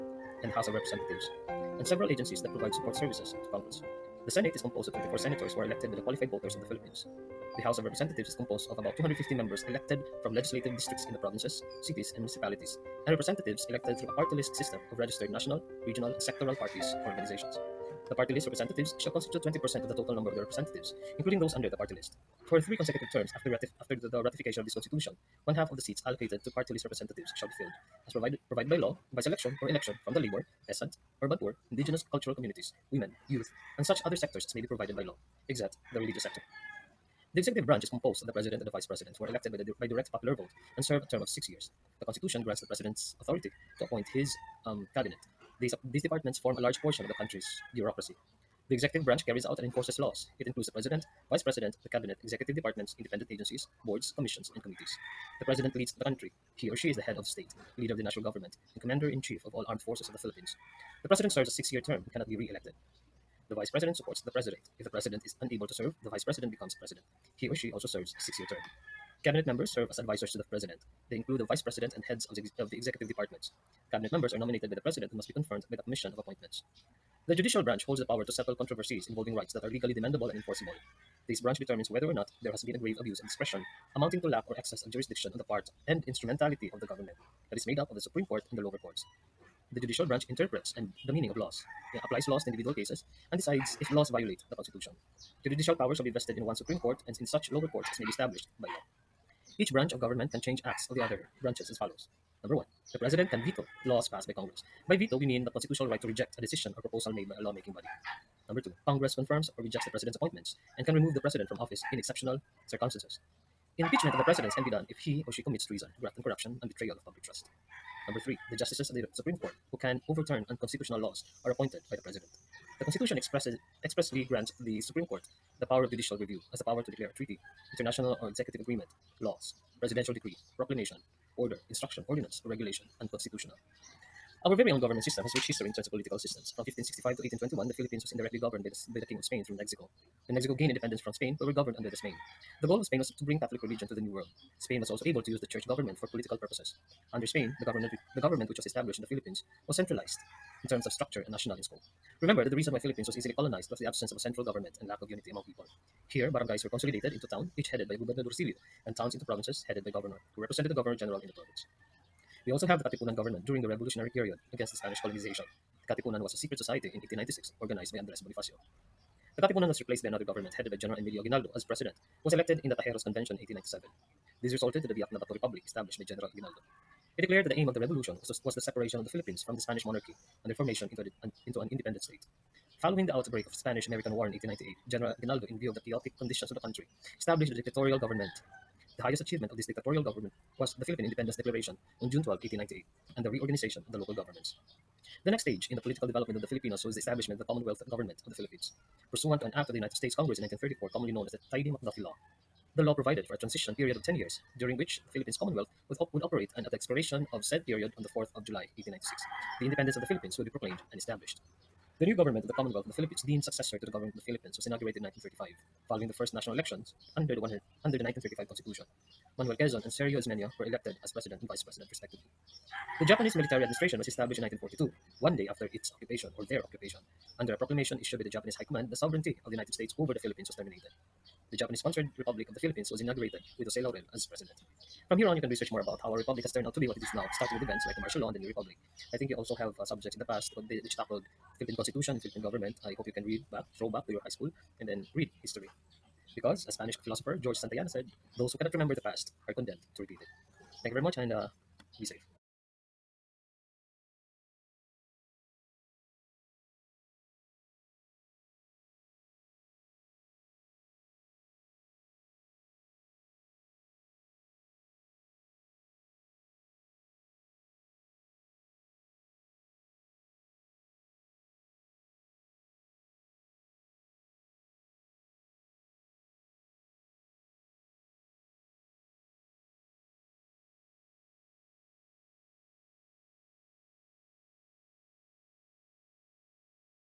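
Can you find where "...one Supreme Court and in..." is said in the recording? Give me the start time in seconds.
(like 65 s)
96 s.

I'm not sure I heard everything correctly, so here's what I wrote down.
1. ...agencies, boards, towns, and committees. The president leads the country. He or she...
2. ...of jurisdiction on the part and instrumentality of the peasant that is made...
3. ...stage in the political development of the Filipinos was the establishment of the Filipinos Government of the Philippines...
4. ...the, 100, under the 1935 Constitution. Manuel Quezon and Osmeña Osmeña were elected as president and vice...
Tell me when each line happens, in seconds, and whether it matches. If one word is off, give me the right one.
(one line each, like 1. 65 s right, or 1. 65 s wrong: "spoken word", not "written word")
1. 53 s wrong: "commissions", not "towns"
2. 84 s wrong: "government", not "peasant"
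3. 195 s wrong: "Commonwealth", not "Filipinos"
4. 217 s wrong: "Sergio", not "Osmeña".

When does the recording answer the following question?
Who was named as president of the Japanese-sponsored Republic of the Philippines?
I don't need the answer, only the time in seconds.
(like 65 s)
233 s.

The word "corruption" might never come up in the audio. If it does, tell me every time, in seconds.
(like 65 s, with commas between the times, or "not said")
116 s.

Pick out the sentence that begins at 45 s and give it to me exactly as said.
These, uh, these departments form a large portion of the country's bureaucracy.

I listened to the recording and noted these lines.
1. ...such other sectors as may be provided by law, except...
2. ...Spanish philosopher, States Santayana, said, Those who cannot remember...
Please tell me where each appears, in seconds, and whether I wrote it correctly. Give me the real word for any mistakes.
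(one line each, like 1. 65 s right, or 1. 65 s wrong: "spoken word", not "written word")
1. 33 s right
2. 246 s wrong: "George", not "States".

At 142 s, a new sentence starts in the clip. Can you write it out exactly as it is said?
The goal of Spain was to bring Catholic religion to the New World.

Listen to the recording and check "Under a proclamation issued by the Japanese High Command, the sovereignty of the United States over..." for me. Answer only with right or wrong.
right.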